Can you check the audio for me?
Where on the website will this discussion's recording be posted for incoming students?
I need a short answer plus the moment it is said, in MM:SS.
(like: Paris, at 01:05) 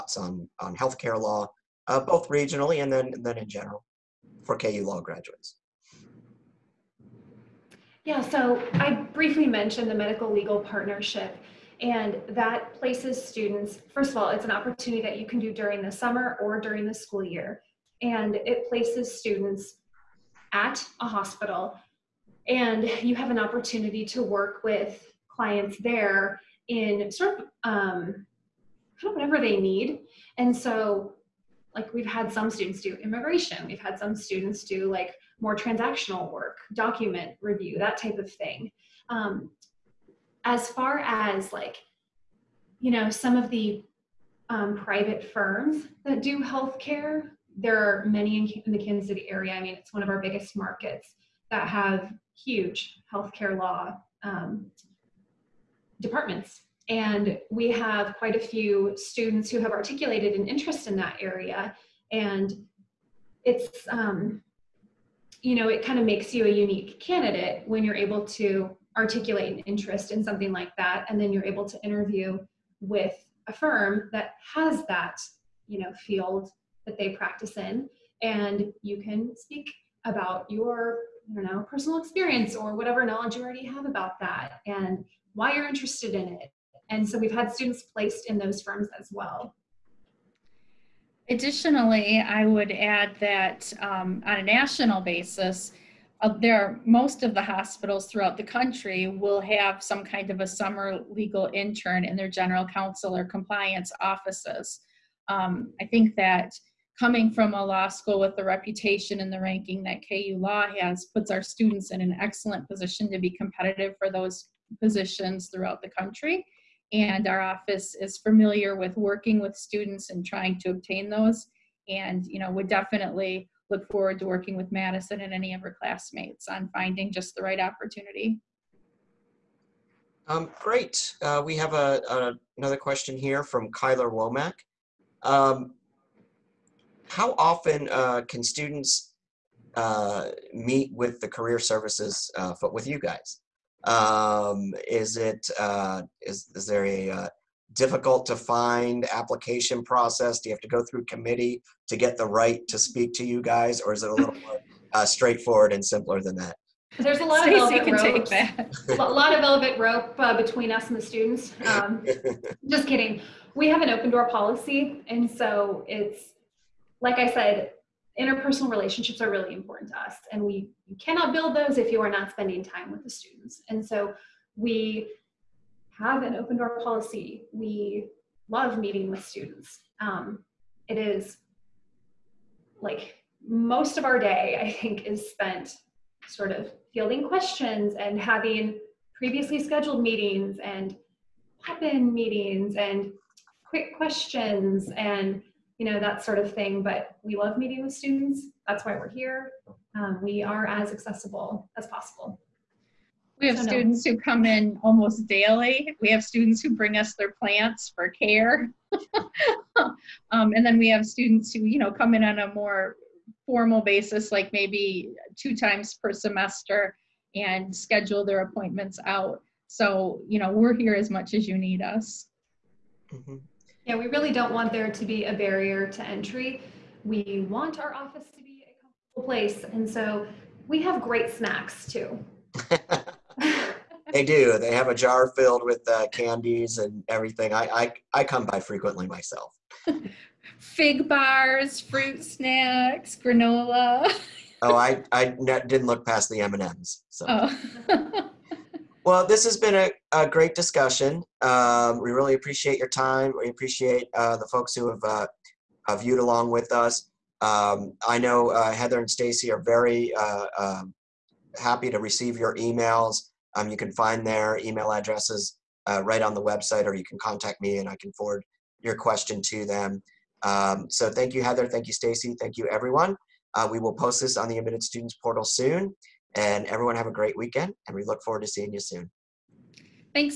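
Admitted Students portal, at 04:34.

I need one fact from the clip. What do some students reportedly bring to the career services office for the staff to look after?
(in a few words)
Plants.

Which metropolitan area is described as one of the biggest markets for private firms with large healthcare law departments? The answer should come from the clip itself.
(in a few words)
Kansas City.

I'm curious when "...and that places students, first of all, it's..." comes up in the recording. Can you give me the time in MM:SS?
00:11.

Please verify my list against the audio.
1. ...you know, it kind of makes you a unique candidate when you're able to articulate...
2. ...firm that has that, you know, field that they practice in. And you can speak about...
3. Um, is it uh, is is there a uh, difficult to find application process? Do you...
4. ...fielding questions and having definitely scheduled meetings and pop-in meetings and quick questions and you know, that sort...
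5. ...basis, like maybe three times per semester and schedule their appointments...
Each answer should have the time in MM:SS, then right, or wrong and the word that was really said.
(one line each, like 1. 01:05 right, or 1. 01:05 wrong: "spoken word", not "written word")
1. 01:05 right
2. 01:13 right
3. 02:23 right
4. 03:06 wrong: "previously", not "definitely"
5. 03:33 wrong: "two", not "three".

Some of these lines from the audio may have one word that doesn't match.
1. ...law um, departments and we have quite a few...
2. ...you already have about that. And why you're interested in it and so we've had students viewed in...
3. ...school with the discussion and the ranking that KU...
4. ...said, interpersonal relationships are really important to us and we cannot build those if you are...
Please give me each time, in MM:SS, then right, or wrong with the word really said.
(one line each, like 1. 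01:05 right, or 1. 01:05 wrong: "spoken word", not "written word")
1. 00:53 right
2. 01:23 wrong: "placed", not "viewed"
3. 01:47 wrong: "reputation", not "discussion"
4. 02:47 right.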